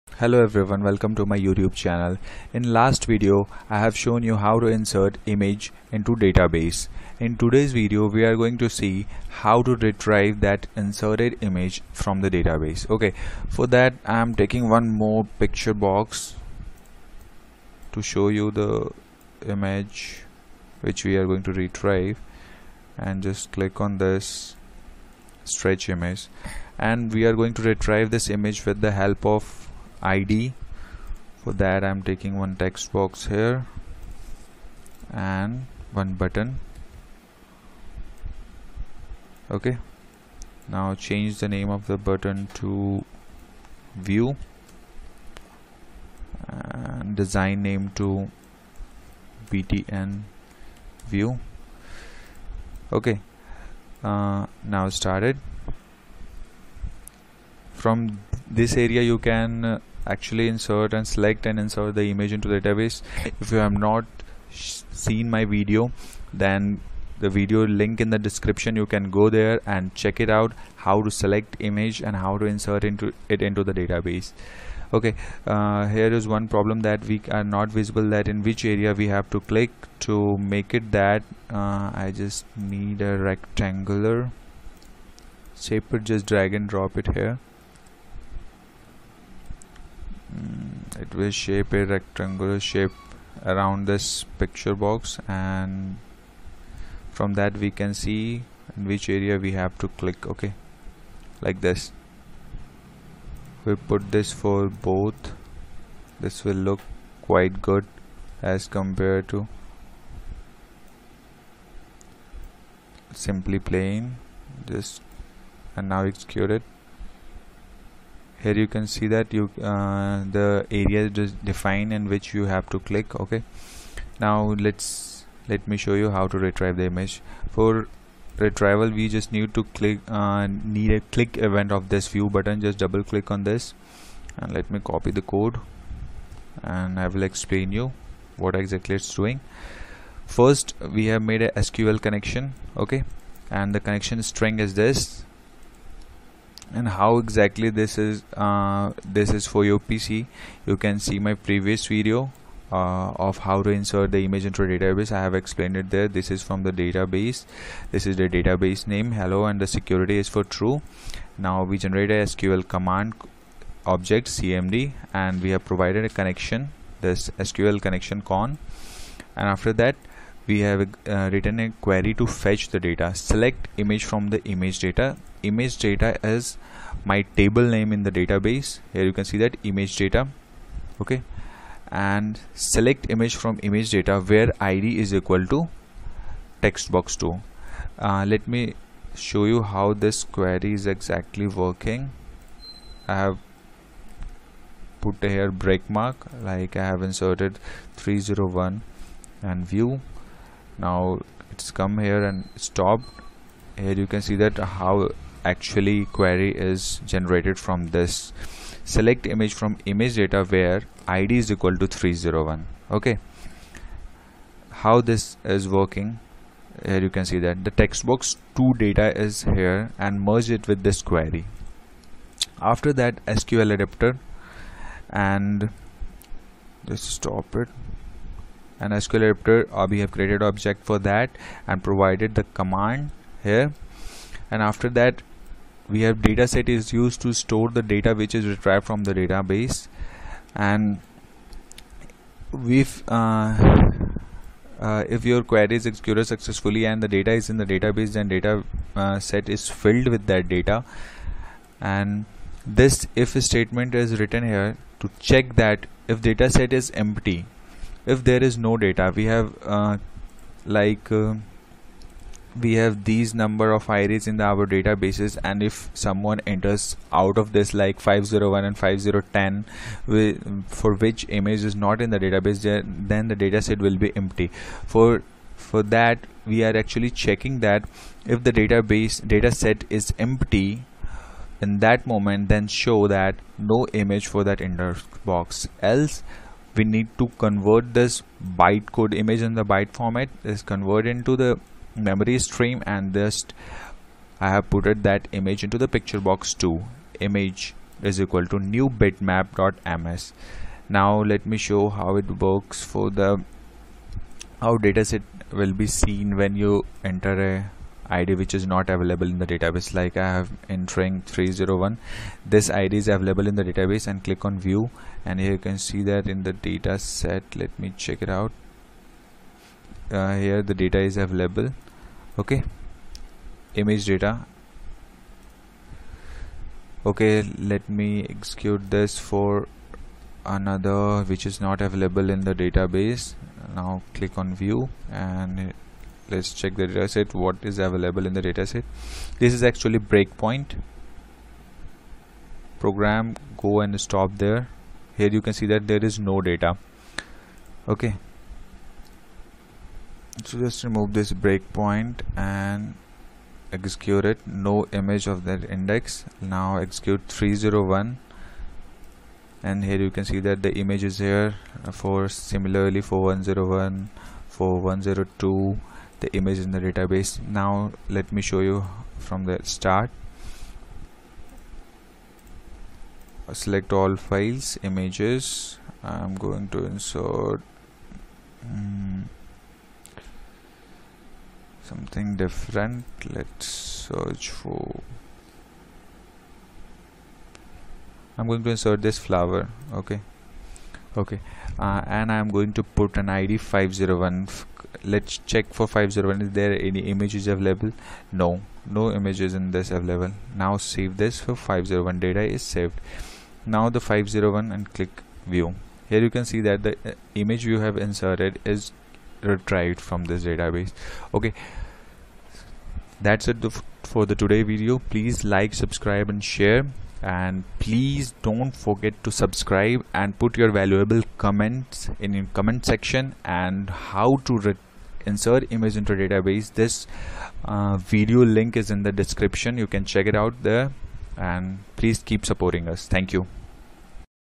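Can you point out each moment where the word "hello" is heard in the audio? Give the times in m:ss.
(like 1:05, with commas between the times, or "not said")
0:00, 2:39.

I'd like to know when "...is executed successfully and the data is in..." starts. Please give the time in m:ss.
4:05.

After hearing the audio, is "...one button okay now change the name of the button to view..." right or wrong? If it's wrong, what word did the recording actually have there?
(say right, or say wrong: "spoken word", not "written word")
right.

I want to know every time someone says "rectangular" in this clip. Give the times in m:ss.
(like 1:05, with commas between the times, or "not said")
1:23, 1:31.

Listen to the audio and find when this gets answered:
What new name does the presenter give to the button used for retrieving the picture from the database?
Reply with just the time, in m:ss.
0:49.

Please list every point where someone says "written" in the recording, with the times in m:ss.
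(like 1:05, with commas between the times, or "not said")
2:51, 4:14.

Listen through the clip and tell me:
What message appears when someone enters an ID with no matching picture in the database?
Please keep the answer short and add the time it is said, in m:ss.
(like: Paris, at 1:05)
no image of that index, at 5:54.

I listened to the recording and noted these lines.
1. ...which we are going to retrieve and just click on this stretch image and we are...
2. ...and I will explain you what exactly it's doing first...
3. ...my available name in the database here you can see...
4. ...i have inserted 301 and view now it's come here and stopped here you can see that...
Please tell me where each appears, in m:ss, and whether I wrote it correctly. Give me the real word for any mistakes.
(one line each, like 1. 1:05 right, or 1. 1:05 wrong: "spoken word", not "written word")
1. 0:20 right
2. 2:16 right
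3. 2:57 wrong: "table", not "available"
4. 3:16 right.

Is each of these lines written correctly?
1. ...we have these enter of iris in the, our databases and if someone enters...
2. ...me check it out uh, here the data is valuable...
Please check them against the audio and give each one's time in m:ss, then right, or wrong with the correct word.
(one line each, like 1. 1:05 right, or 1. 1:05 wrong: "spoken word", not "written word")
1. 4:22 wrong: "number", not "enter"
2. 5:17 wrong: "available", not "valuable".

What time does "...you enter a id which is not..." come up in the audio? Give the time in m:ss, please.
5:06.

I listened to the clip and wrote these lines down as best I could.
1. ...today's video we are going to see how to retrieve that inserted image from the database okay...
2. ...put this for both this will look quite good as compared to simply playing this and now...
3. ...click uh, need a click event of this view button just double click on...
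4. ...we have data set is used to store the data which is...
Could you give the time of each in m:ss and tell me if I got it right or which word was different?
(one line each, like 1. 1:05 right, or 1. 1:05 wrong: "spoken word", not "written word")
1. 0:07 right
2. 1:43 right
3. 2:09 right
4. 3:55 right.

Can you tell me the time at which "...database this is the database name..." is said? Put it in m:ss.
2:36.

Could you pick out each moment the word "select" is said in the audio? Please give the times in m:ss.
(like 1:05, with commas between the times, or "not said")
1:01, 1:11, 2:53, 3:02, 3:28, 6:13.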